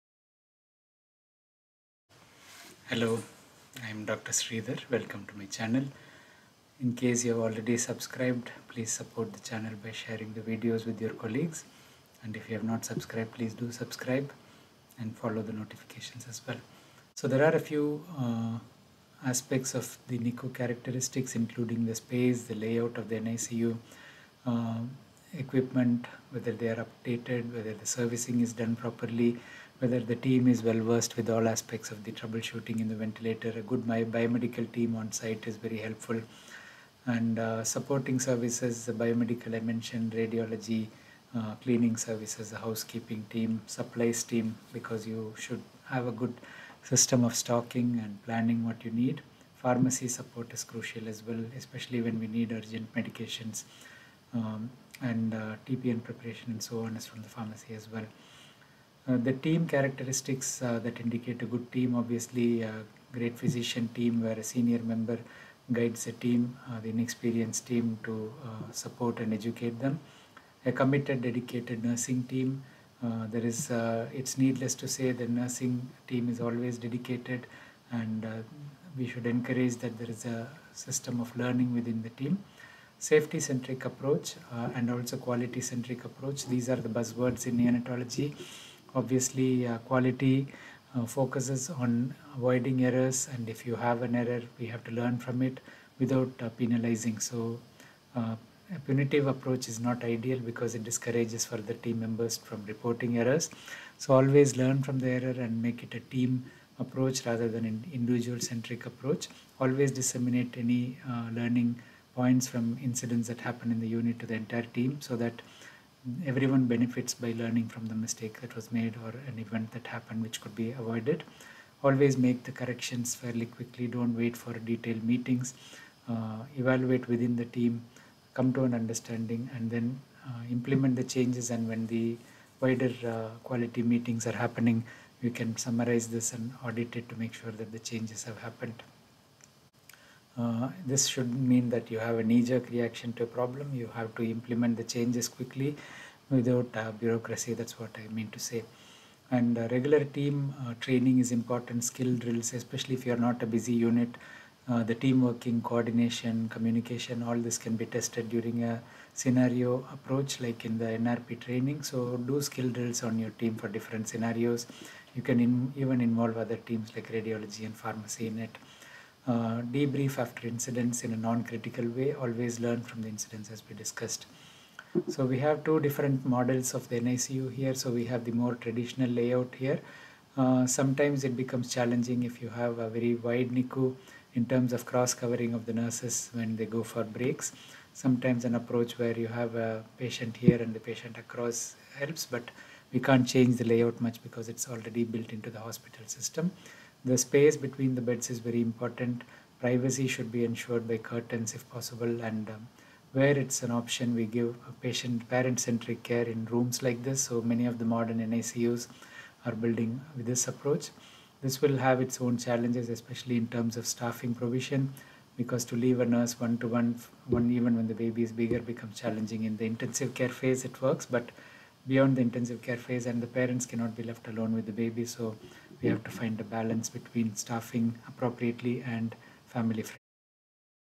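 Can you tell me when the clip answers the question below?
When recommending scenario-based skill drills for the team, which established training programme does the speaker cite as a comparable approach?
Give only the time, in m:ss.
2:40.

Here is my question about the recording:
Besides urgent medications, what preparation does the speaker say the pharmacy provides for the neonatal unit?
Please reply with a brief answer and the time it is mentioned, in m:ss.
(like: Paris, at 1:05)
TPN preparation, at 0:55.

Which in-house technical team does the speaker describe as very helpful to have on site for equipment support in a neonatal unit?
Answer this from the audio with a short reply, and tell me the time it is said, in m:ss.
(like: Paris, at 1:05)
Biomedical team, at 0:33.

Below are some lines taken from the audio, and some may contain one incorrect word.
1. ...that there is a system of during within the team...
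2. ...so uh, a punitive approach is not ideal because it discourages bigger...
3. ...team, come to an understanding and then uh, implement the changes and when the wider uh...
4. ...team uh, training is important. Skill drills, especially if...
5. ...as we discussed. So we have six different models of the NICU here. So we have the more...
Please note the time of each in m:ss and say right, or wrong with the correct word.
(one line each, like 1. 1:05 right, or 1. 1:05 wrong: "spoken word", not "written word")
1. 1:19 wrong: "learning", not "during"
2. 1:37 wrong: "further", not "bigger"
3. 2:07 right
4. 2:30 right
5. 2:53 wrong: "two", not "six".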